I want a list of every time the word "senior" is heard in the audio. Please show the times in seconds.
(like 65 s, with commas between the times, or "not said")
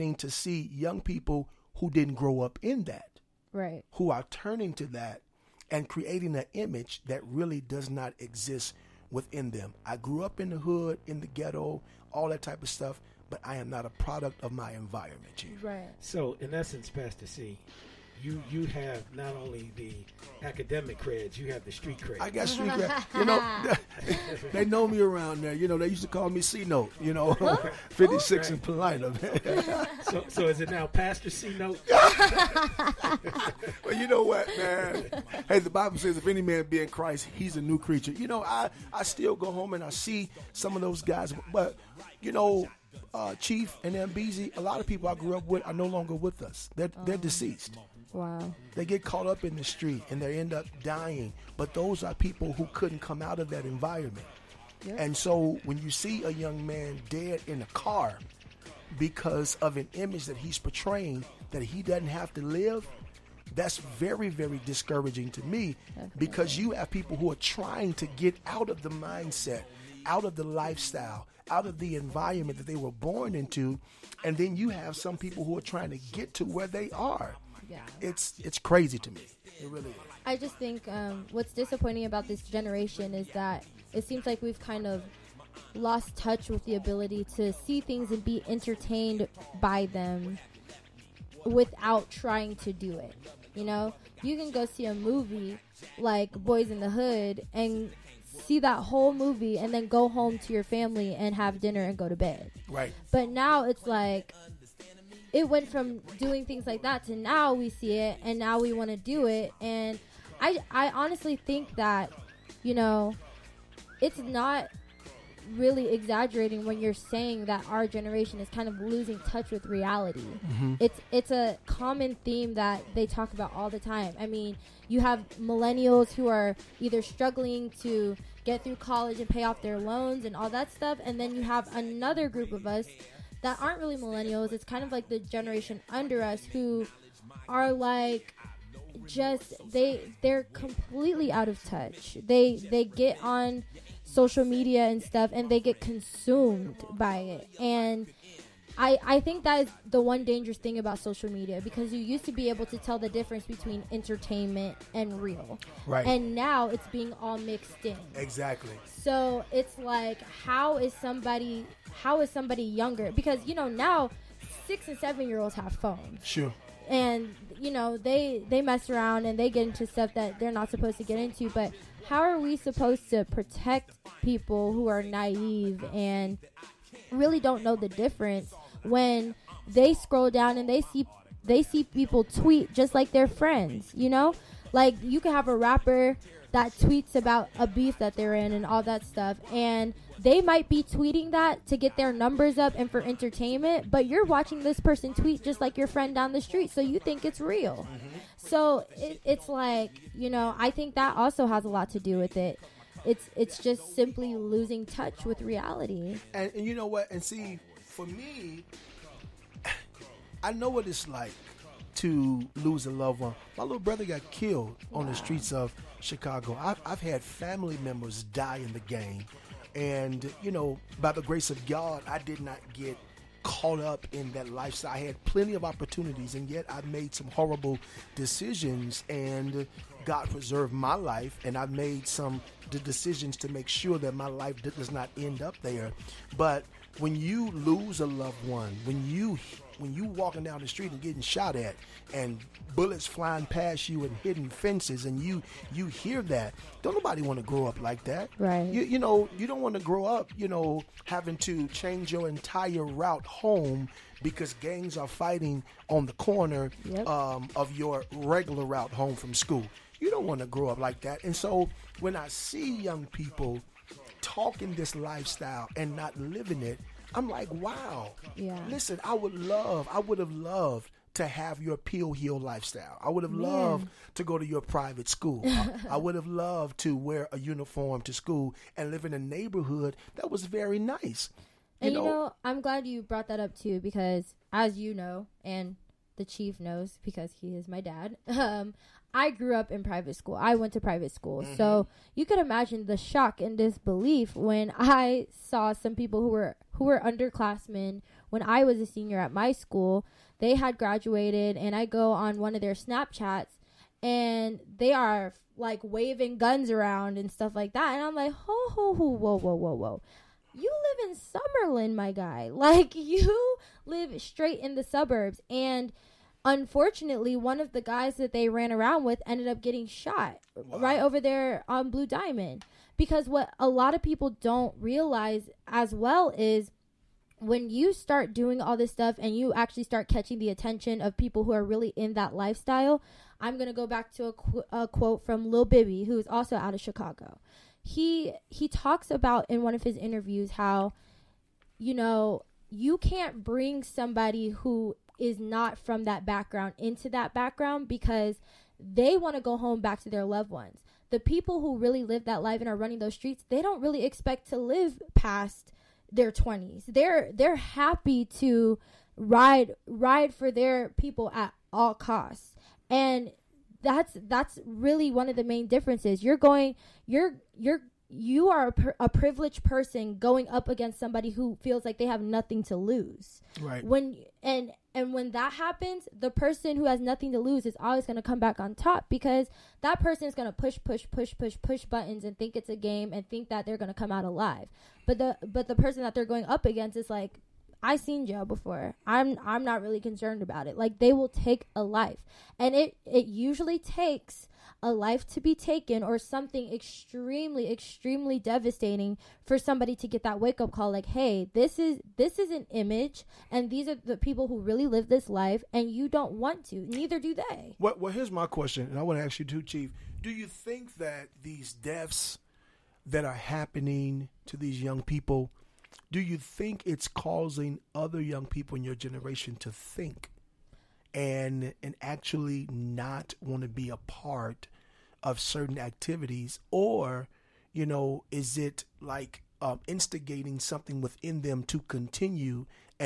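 298 s.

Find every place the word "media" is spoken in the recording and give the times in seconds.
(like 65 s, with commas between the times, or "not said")
144 s, 151 s.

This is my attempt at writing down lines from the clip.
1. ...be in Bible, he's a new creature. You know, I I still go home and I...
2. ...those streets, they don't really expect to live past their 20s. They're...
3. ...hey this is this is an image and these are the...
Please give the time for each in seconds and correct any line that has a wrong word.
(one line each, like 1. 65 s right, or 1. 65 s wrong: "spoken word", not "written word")
1. 36 s wrong: "Christ", not "Bible"
2. 352 s right
3. 401 s right.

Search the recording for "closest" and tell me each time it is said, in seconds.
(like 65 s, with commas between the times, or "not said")
not said.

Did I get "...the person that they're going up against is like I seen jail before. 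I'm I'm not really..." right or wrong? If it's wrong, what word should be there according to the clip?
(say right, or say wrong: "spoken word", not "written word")
right.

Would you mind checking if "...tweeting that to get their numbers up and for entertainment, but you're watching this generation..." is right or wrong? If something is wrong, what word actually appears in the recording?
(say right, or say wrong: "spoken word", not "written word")
wrong: "person", not "generation".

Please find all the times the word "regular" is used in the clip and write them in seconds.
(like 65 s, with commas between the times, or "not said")
258 s.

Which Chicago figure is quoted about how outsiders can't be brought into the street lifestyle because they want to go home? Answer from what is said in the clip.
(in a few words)
Lil Bibby.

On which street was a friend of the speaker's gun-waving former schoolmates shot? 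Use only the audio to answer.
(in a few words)
Blue Diamond.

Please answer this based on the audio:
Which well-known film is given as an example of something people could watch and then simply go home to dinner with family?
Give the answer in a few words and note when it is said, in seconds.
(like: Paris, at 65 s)
Boyz n the Hood, at 96 s.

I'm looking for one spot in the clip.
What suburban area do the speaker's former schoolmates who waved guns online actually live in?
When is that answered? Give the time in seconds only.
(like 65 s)
311 s.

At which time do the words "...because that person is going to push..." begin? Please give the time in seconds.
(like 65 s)
379 s.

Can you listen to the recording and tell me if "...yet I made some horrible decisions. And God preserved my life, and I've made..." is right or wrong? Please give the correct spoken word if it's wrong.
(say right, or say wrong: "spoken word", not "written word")
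right.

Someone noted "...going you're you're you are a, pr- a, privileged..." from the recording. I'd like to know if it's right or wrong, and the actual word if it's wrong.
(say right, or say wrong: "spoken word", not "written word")
right.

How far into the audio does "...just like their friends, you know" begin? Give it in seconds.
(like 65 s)
182 s.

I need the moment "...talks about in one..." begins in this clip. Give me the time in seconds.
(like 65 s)
338 s.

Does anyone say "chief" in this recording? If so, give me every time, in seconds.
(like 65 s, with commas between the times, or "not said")
15 s, 43 s, 286 s, 409 s.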